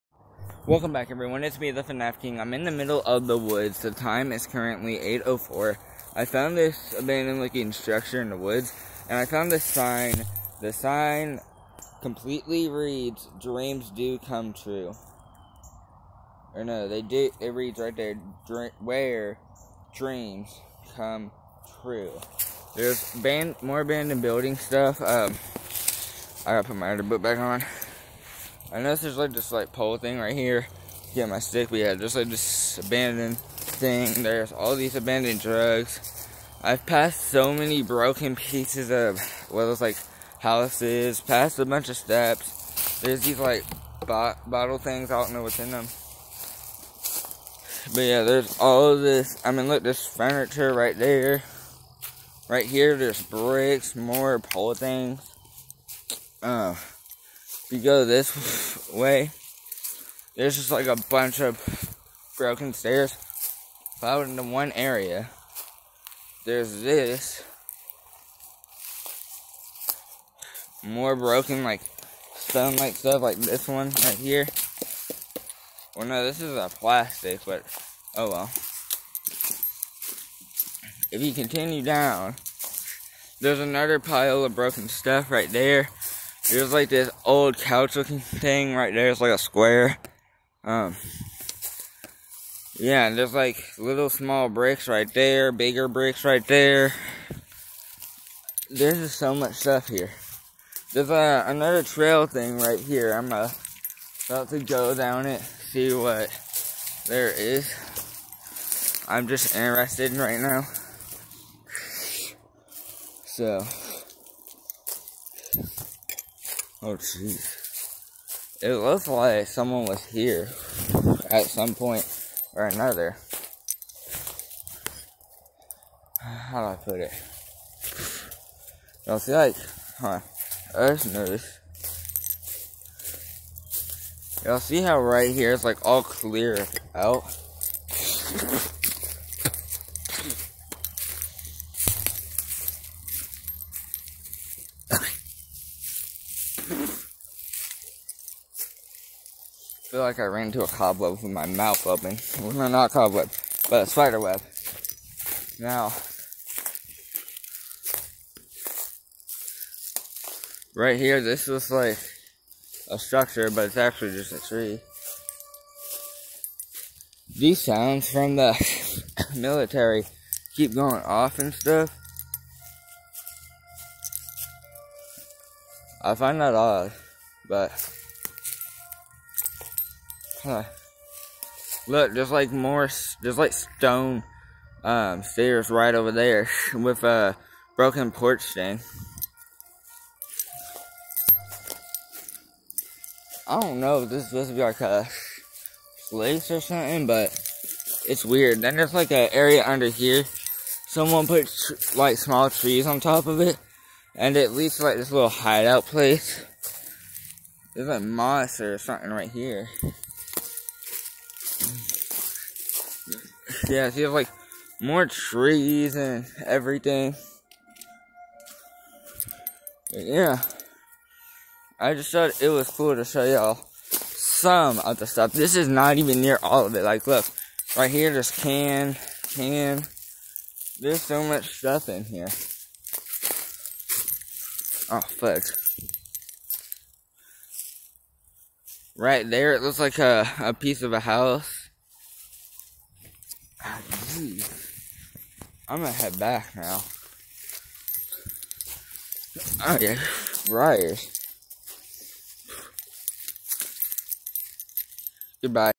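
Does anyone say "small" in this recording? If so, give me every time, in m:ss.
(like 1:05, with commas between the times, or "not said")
1:34, 3:22.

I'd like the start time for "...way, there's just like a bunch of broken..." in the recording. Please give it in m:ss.
0:58.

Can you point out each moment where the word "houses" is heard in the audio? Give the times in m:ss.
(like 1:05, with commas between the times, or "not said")
0:40, 4:00.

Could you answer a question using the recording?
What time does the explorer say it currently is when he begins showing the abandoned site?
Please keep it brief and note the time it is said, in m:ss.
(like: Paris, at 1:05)
8:04, at 0:04.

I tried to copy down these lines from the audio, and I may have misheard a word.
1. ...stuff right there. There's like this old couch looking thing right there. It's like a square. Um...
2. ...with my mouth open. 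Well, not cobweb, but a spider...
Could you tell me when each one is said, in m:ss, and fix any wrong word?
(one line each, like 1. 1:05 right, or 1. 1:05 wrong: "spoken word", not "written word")
1. 1:24 right
2. 2:31 right.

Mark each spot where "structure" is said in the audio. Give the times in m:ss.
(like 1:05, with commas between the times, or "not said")
0:07, 2:42.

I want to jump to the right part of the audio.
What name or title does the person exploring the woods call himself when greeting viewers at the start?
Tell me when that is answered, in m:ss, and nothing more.
0:01.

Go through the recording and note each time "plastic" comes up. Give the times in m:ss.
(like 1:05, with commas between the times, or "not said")
1:16.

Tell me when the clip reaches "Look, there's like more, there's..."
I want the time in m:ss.
3:01.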